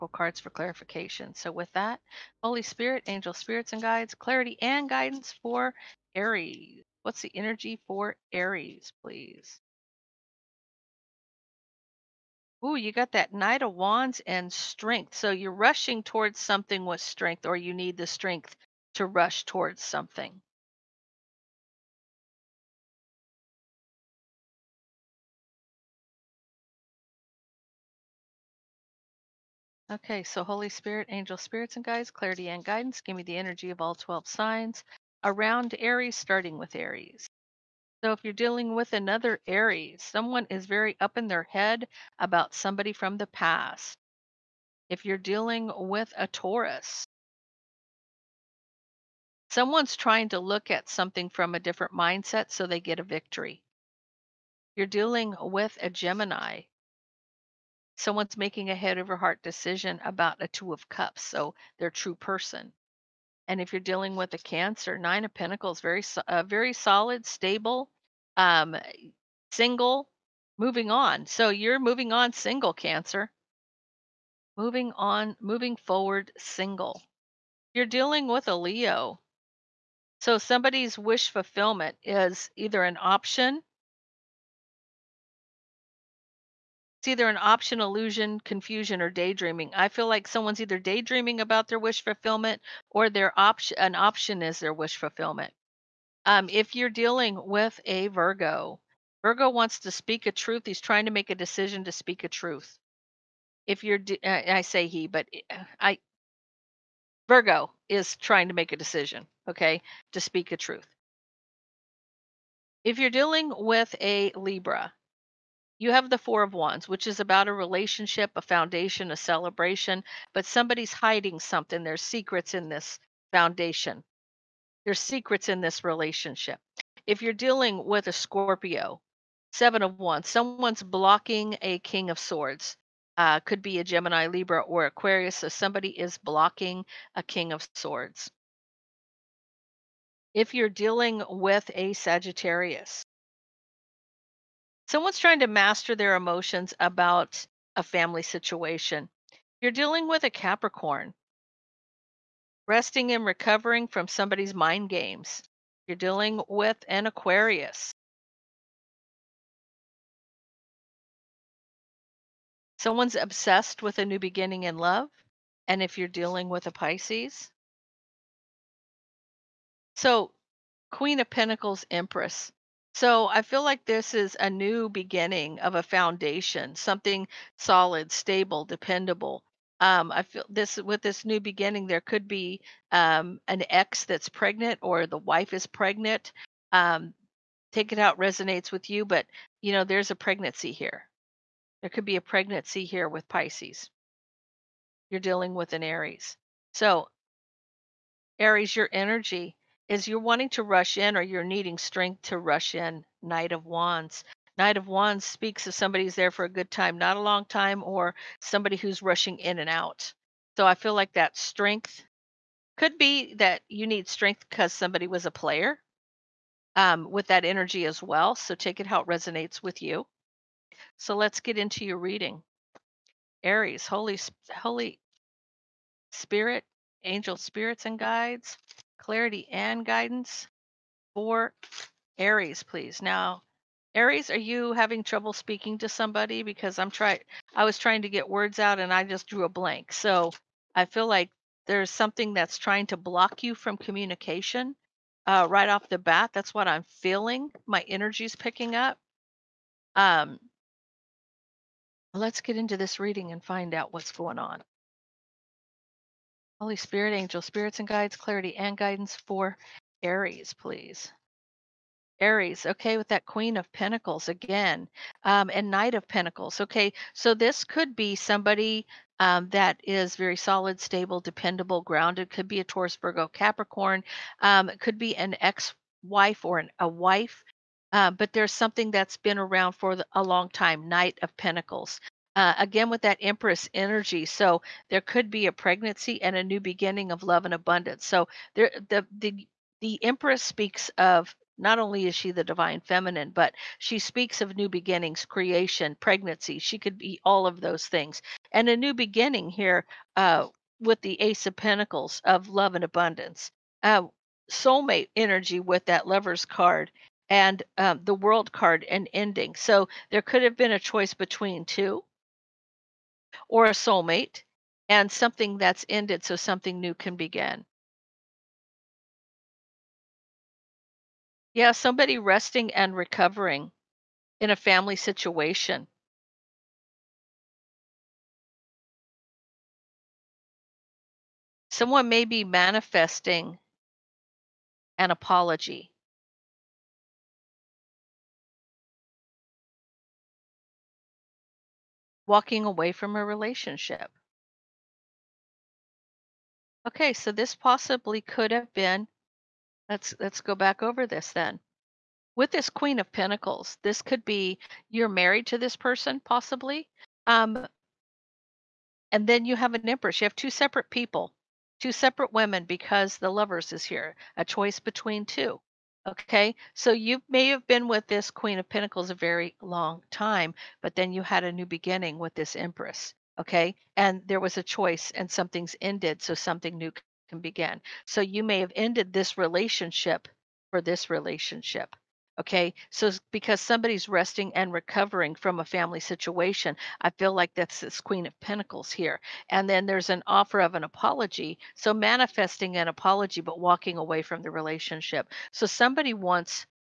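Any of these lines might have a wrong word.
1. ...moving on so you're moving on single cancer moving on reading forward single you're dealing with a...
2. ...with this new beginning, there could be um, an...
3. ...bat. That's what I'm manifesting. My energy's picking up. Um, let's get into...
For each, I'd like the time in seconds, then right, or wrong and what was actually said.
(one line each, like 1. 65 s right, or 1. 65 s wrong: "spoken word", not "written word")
1. 70 s wrong: "moving", not "reading"
2. 180 s right
3. 245 s wrong: "feeling", not "manifesting".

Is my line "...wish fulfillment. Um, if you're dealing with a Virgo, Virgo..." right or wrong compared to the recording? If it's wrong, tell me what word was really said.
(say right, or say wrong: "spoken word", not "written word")
right.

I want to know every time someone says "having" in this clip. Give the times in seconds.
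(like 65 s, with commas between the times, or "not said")
234 s.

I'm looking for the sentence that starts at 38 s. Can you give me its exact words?
So if you're dealing with another Aries, someone is very up in their head about somebody from the past.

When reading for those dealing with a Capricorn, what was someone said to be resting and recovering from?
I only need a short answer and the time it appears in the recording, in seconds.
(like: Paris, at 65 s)
mind games, at 154 s.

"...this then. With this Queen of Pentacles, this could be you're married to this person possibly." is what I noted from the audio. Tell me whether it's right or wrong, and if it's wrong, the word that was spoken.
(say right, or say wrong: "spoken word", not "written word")
right.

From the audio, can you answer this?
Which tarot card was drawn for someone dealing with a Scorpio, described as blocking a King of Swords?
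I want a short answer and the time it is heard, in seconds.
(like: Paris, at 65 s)
Seven of Wands, at 129 s.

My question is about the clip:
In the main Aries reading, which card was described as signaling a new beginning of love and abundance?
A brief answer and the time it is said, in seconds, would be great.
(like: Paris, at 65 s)
Ace of Pentacles, at 301 s.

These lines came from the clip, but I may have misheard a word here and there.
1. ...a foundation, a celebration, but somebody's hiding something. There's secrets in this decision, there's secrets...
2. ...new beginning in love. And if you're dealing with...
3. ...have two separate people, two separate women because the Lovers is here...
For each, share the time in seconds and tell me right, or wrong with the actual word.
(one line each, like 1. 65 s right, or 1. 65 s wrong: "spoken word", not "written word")
1. 118 s wrong: "foundation", not "decision"
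2. 164 s right
3. 360 s right.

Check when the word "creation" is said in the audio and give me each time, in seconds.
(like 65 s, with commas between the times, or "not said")
295 s.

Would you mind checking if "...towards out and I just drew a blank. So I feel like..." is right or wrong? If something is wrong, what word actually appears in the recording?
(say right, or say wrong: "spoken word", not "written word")
wrong: "words", not "towards".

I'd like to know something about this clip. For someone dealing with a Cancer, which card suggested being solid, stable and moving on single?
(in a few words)
Nine of Pentacles.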